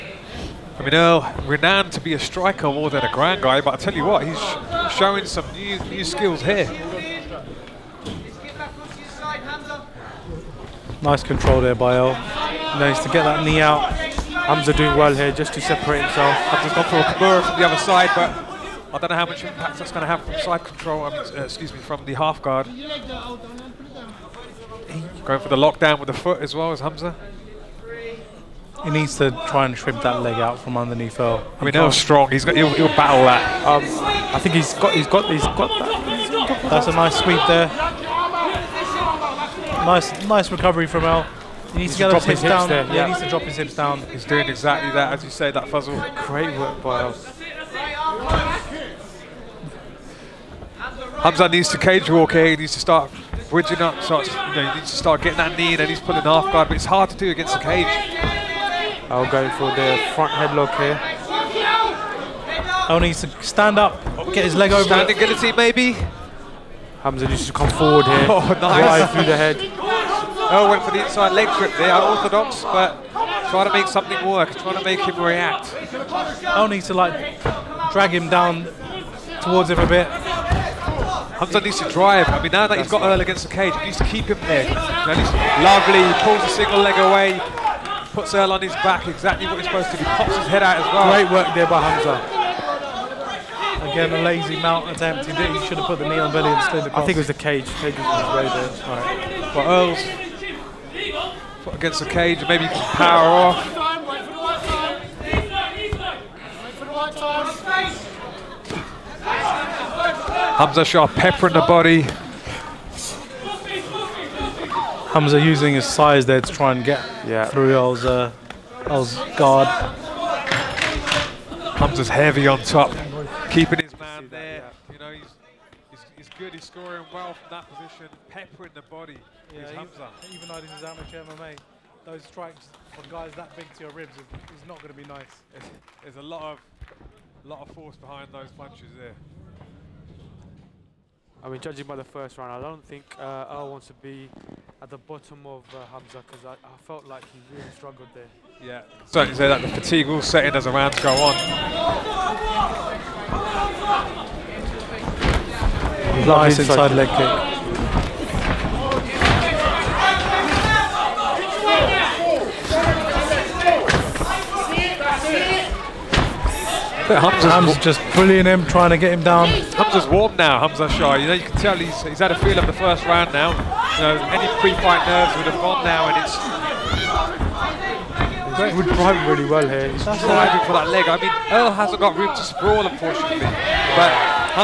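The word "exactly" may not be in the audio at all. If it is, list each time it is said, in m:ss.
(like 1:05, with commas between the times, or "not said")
0:44, 1:29.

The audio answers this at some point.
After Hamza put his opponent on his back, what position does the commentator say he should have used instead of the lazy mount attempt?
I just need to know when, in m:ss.
1:36.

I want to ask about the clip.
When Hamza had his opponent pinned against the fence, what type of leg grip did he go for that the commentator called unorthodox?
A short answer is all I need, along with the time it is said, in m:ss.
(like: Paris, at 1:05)
inside leg grip, at 1:11.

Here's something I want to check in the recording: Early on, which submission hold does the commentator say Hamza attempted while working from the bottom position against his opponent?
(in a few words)
Kimura.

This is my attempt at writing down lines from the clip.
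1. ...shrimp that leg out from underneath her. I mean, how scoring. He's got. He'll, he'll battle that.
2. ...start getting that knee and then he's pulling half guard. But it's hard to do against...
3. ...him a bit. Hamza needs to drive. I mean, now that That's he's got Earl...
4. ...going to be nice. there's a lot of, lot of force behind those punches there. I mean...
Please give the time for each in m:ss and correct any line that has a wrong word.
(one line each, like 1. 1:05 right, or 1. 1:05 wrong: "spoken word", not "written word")
1. 0:29 wrong: "strong", not "scoring"
2. 0:54 right
3. 1:19 right
4. 2:14 right.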